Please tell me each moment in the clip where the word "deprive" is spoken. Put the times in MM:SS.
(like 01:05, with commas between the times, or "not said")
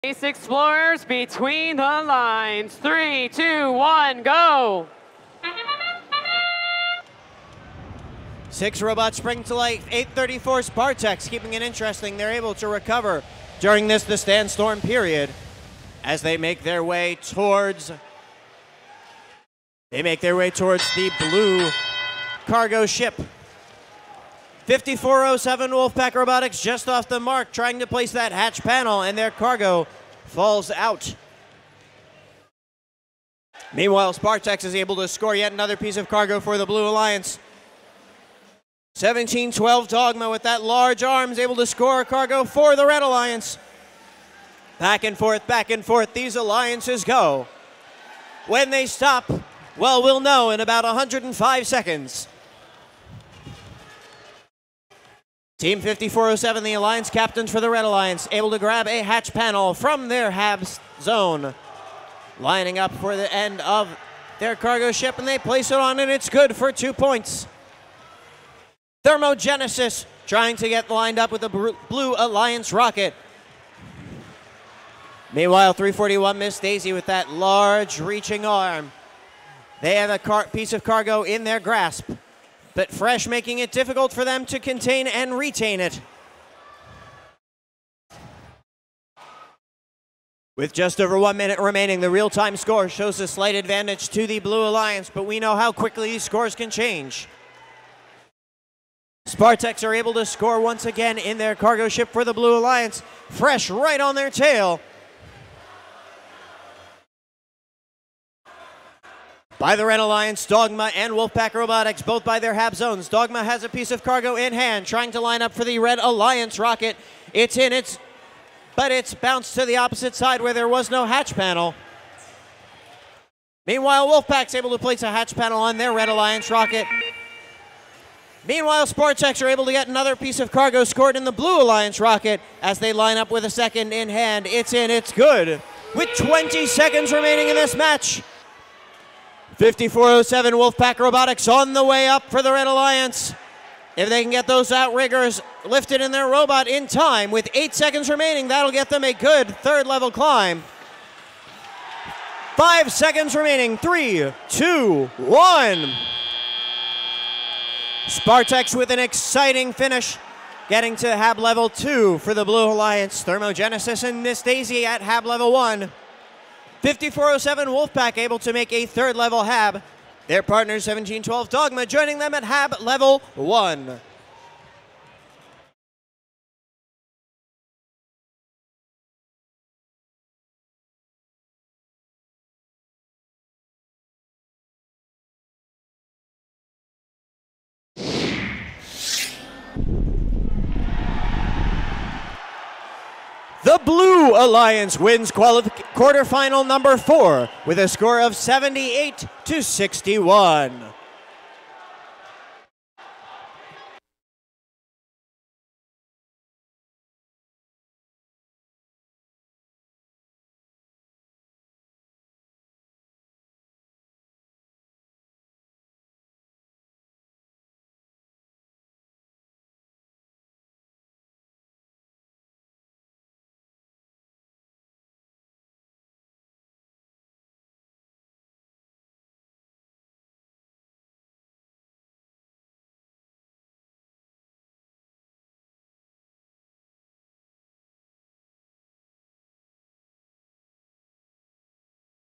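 not said.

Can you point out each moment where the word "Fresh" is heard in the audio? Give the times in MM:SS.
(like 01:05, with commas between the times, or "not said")
01:22, 01:43.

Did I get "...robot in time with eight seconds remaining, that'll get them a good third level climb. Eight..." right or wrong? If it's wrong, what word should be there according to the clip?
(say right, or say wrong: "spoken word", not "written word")
wrong: "Five", not "Eight".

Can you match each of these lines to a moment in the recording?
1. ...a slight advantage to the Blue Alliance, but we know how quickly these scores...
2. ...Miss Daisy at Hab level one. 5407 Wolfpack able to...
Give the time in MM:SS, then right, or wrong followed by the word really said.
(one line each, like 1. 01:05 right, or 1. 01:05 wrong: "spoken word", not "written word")
1. 01:33 right
2. 02:44 right.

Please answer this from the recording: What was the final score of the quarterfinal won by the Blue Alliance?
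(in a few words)
78 to 61.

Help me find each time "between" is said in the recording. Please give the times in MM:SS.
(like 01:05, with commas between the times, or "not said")
00:01.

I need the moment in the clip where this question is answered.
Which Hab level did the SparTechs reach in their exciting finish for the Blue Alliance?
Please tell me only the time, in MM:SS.
02:41.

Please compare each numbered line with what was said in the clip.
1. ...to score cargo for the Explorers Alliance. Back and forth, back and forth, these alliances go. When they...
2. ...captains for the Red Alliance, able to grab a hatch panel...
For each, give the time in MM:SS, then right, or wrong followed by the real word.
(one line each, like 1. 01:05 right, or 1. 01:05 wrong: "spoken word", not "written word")
1. 00:41 wrong: "Red", not "Explorers"
2. 00:57 right.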